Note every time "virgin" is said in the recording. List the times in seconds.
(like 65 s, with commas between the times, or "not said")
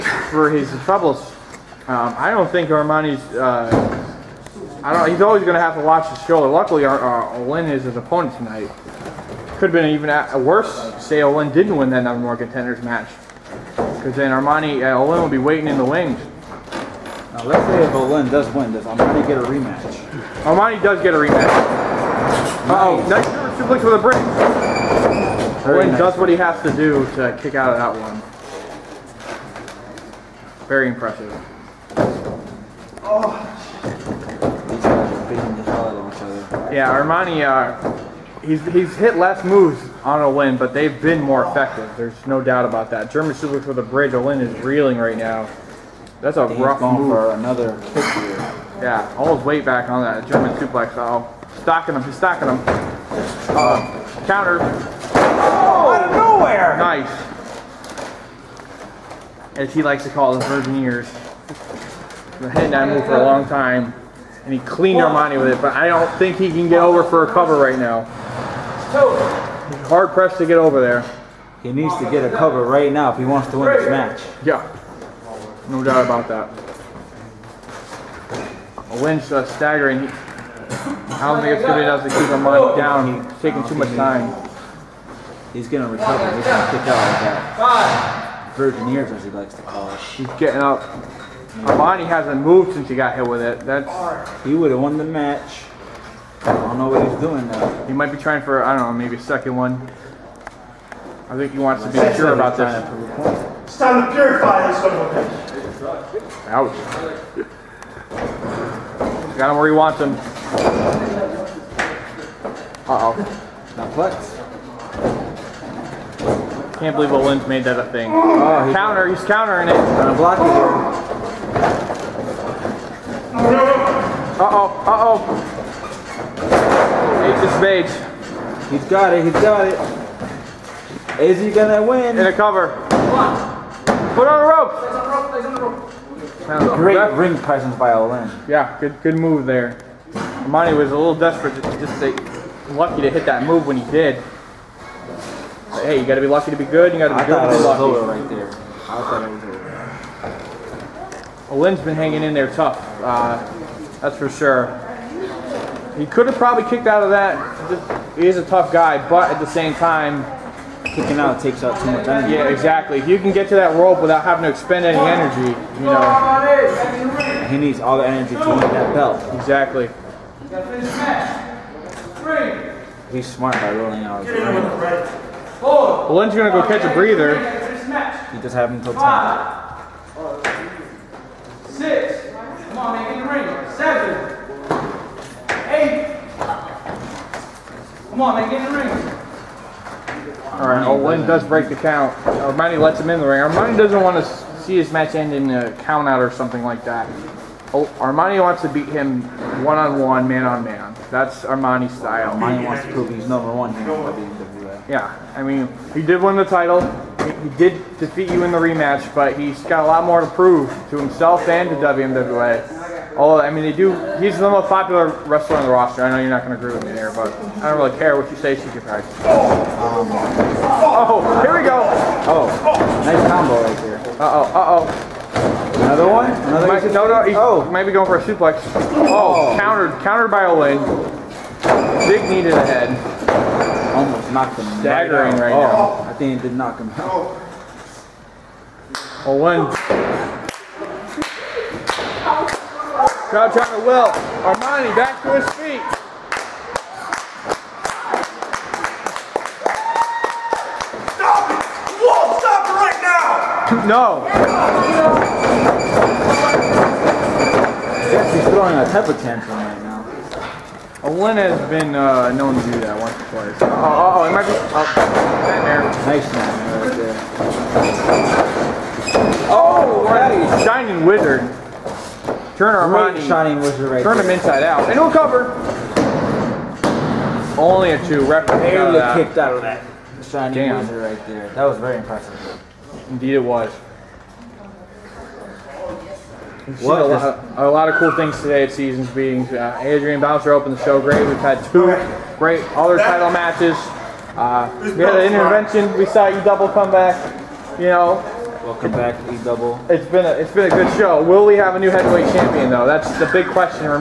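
60 s, 88 s.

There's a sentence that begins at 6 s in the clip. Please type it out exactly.
Luckily, our uh, O'Lynn is his opponent tonight.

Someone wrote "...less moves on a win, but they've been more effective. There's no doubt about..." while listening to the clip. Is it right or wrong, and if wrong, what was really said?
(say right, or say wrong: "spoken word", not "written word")
right.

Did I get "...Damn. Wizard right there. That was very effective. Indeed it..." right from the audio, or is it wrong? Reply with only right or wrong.
wrong.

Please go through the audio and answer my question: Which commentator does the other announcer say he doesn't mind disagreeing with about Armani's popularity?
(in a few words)
CJ Price.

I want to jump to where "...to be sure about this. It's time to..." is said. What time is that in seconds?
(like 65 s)
101 s.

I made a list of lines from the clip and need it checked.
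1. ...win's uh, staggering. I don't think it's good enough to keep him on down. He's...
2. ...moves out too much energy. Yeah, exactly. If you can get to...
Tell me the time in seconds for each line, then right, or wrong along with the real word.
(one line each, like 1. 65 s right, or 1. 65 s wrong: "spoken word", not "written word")
1. 79 s right
2. 161 s wrong: "takes", not "moves".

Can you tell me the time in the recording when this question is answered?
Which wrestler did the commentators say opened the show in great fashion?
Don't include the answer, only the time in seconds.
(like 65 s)
289 s.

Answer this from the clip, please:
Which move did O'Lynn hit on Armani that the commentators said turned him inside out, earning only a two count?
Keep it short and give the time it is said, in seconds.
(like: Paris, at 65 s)
Shining Wizard, at 270 s.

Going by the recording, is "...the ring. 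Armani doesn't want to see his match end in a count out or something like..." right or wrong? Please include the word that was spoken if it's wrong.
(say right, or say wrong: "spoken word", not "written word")
right.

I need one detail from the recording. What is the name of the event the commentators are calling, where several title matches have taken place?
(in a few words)
Seasons Beatings.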